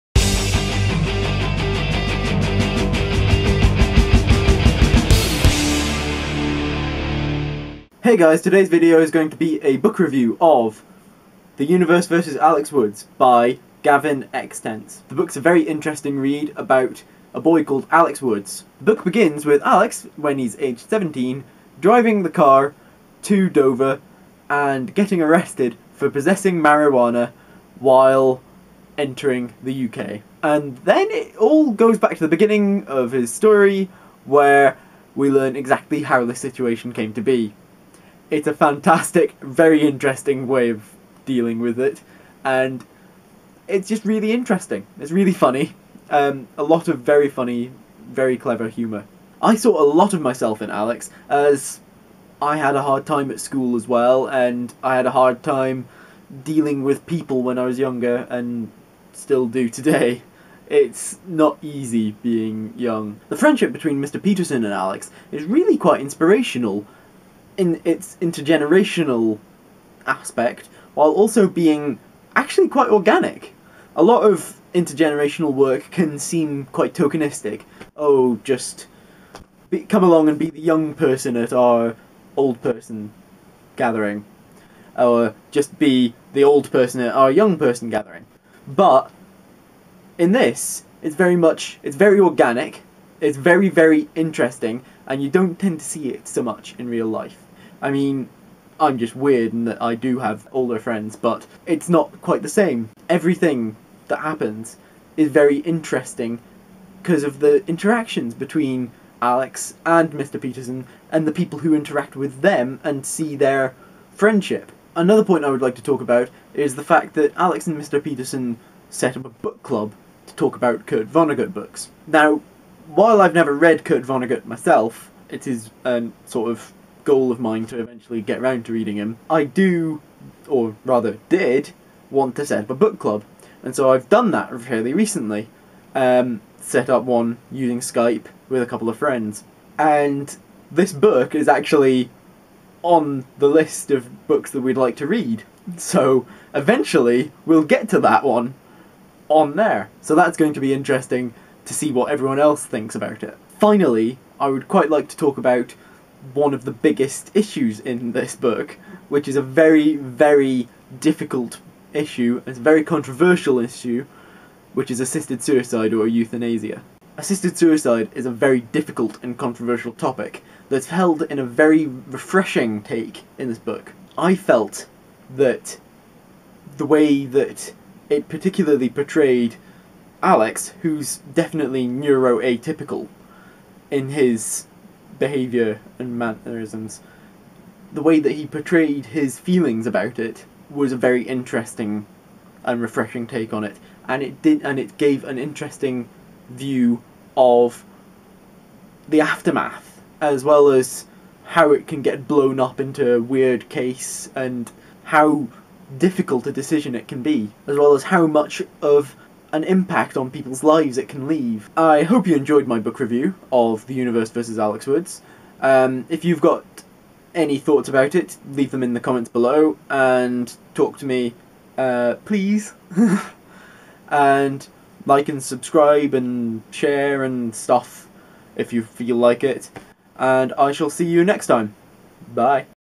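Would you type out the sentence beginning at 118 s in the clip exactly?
Peterson set up a book club to talk about Kurt Vonnegut books.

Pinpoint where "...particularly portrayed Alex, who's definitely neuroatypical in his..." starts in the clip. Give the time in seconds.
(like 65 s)
178 s.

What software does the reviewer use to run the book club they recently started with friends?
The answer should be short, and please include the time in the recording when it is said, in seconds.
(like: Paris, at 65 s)
Skype, at 137 s.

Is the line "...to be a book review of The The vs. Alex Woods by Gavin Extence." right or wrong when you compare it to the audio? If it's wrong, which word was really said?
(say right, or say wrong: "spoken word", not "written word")
wrong: "Universe", not "The".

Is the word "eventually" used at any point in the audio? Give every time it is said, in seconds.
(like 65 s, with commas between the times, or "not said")
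127 s, 146 s.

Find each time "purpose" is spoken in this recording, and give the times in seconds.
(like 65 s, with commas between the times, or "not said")
not said.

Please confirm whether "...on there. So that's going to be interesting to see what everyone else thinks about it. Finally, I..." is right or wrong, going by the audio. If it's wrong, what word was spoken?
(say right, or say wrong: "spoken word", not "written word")
right.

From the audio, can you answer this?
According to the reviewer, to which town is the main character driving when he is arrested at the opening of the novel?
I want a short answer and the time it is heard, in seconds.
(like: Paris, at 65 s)
Dover, at 23 s.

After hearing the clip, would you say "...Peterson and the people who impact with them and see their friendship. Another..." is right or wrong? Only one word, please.
wrong.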